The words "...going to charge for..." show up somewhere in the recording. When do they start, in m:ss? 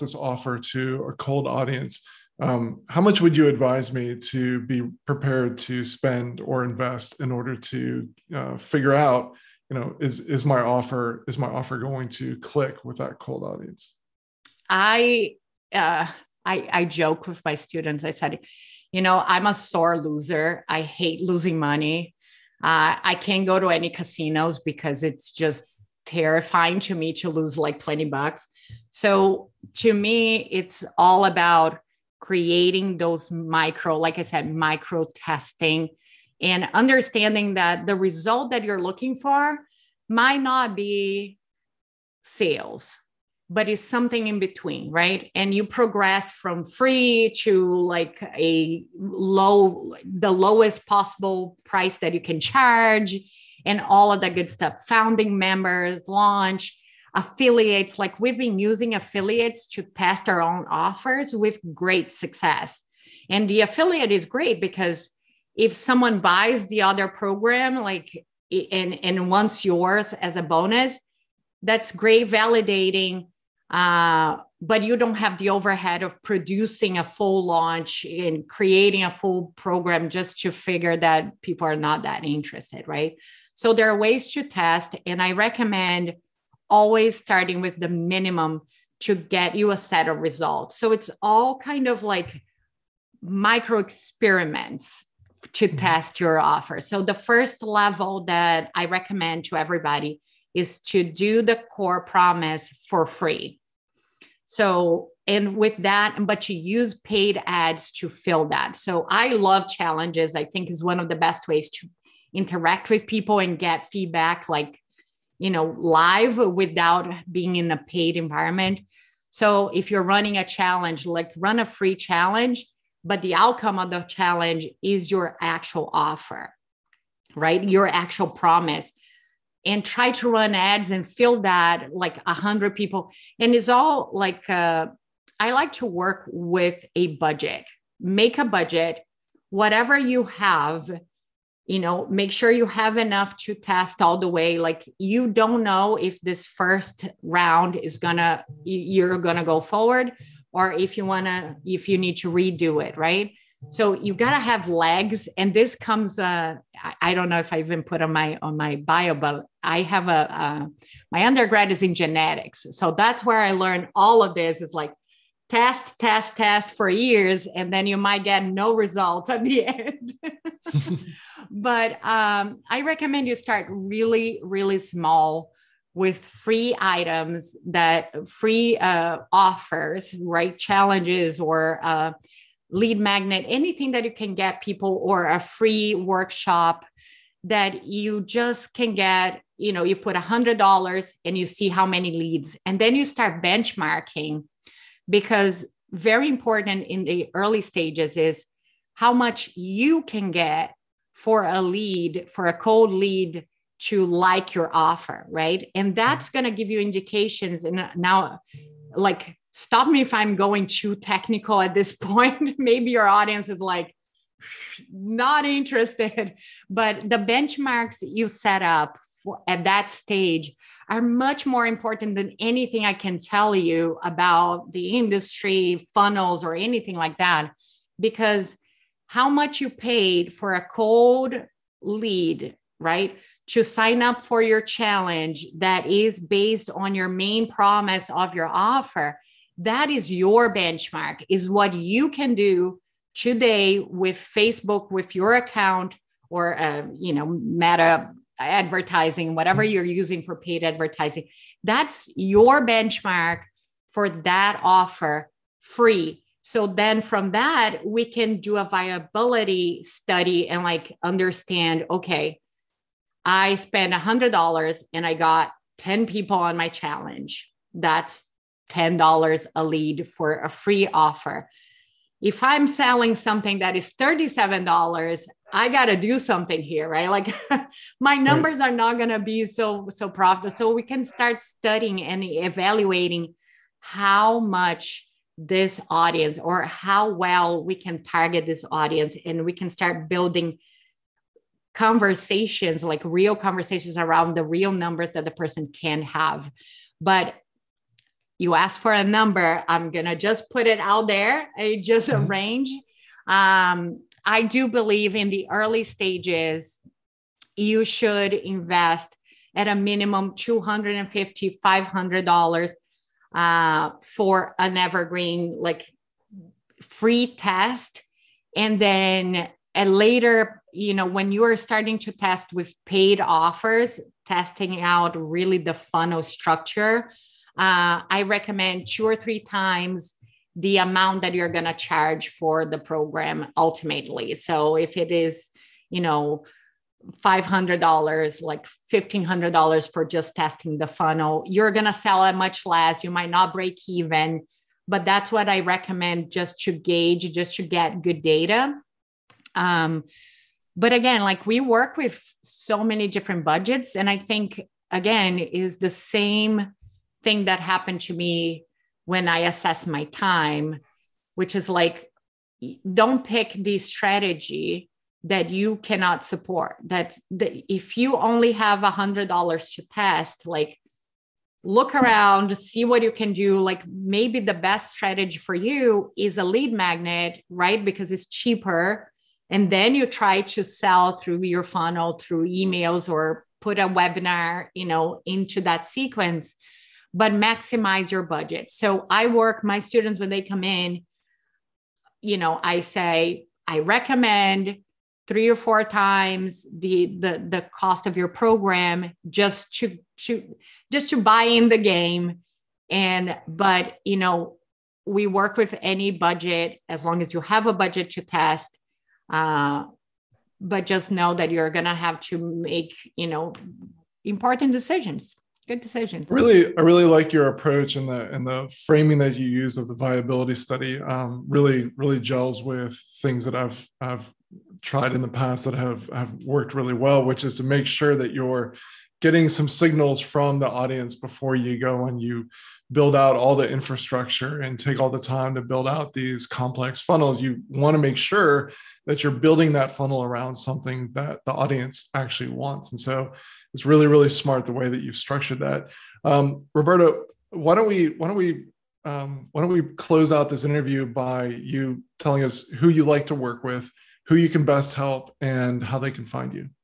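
5:31.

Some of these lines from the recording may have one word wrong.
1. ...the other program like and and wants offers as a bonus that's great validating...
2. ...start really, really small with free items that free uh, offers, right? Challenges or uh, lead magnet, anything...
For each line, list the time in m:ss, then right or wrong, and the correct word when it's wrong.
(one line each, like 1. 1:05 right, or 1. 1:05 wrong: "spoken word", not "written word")
1. 1:06 wrong: "yours", not "offers"
2. 2:53 right.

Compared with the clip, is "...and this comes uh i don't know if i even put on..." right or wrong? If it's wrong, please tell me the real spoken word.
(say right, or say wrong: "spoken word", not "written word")
right.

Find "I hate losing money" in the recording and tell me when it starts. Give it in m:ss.
0:20.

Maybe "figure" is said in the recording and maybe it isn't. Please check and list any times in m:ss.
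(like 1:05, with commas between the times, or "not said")
0:08, 1:20.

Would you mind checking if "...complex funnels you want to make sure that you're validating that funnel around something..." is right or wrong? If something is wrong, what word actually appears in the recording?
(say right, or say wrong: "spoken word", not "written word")
wrong: "building", not "validating".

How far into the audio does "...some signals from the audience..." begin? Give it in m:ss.
7:09.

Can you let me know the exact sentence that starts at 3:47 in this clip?
Because how much you paid for a cold lead, right?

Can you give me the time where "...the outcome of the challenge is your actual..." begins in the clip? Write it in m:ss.
2:03.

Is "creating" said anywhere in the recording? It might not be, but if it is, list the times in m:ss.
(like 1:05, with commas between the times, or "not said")
0:32, 1:18.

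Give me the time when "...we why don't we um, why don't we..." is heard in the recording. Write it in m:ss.
7:27.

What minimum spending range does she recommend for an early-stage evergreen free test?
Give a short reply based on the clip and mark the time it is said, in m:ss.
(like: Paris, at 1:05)
$250 to $500, at 5:10.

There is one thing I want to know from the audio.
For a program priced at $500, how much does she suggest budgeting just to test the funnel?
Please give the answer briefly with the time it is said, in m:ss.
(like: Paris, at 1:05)
$1500, at 5:38.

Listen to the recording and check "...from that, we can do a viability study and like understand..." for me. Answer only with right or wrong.
right.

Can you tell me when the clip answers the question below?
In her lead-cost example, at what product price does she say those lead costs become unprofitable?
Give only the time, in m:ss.
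4:33.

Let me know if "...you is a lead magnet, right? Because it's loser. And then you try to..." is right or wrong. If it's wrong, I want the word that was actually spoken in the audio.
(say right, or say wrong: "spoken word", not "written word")
wrong: "cheaper", not "loser".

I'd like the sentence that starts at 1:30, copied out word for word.
So it's all kind of like micro experiments to mm-hmm.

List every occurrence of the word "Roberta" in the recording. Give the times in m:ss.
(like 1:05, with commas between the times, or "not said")
7:26.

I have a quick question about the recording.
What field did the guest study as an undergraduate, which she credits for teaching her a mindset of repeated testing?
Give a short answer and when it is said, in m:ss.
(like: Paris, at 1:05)
Genetics, at 2:41.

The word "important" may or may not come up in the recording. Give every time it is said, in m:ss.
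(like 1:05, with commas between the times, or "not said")
3:16, 3:41, 6:54.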